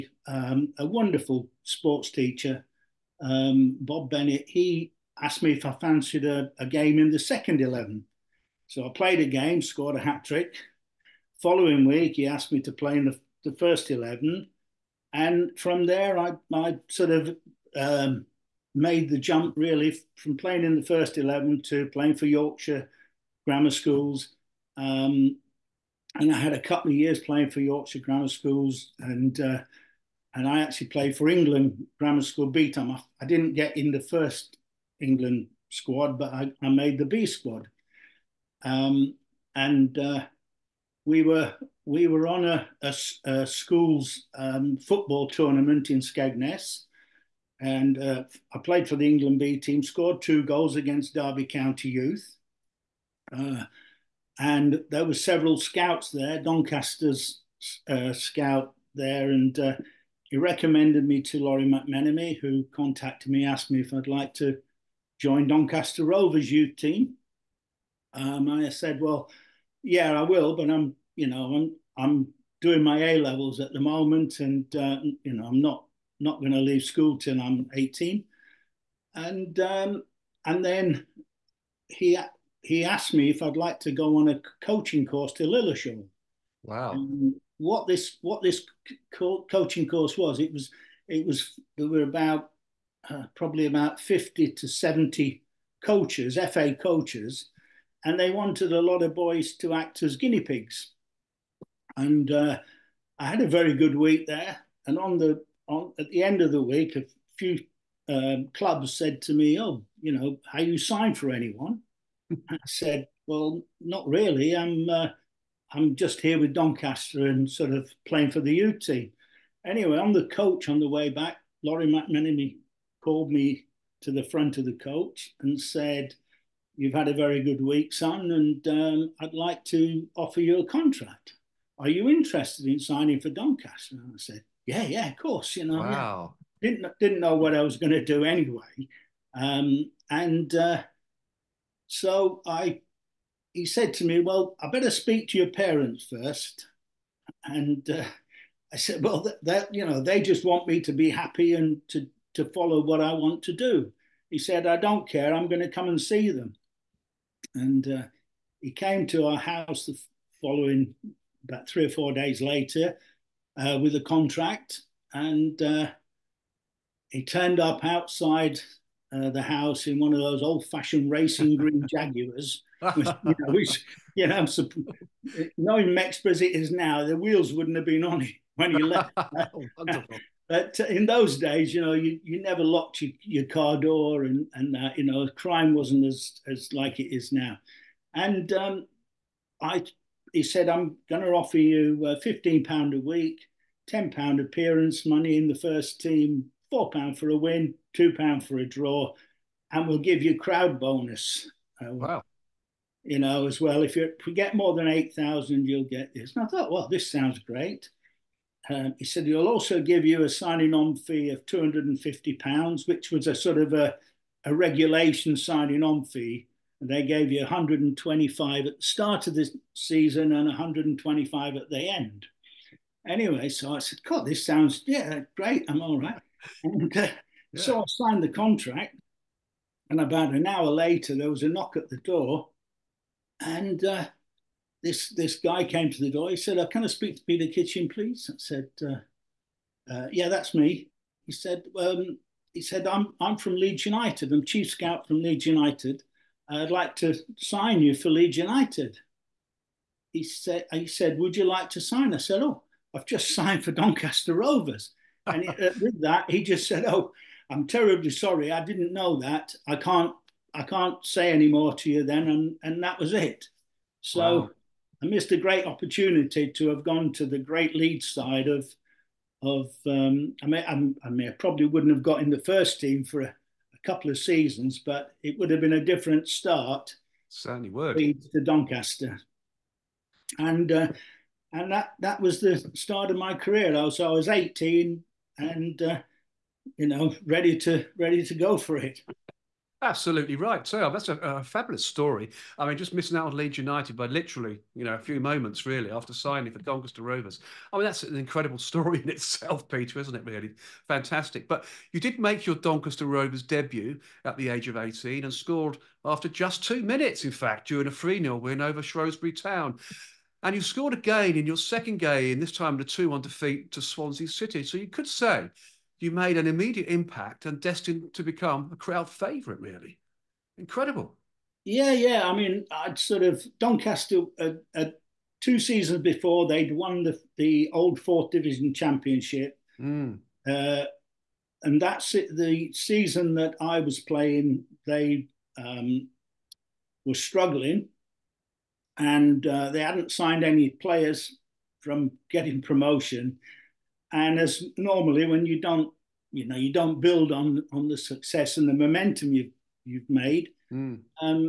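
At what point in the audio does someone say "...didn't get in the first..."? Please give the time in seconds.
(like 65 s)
33 s.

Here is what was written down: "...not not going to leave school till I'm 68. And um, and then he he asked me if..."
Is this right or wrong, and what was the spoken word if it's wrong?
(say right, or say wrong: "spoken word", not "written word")
wrong: "18", not "68".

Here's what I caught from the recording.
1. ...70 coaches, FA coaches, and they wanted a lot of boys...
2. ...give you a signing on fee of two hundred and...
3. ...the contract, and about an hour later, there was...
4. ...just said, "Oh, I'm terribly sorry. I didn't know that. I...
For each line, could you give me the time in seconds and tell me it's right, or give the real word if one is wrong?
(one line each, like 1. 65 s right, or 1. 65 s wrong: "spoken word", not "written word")
1. 94 s right
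2. 209 s right
3. 228 s right
4. 256 s right.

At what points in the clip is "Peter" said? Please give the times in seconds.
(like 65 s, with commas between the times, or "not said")
237 s, 299 s.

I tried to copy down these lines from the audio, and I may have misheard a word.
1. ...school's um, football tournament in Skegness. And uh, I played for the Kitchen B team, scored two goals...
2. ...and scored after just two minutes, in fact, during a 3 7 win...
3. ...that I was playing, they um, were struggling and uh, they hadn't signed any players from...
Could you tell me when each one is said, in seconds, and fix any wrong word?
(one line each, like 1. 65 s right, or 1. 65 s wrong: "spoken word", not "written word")
1. 43 s wrong: "England", not "Kitchen"
2. 305 s wrong: "0", not "7"
3. 333 s right.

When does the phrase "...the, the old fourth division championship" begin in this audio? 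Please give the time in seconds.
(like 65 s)
327 s.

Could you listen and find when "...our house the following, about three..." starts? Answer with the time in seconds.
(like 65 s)
159 s.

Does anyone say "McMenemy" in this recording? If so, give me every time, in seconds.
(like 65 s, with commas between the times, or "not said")
61 s, 121 s.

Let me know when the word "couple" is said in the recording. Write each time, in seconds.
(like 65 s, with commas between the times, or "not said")
26 s, 273 s.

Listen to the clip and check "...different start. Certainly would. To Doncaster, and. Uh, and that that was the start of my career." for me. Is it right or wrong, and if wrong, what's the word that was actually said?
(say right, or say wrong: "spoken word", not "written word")
right.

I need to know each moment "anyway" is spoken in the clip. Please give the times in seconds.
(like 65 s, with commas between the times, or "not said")
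119 s, 138 s, 223 s.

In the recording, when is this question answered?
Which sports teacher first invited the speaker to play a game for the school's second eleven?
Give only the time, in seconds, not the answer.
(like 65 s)
3 s.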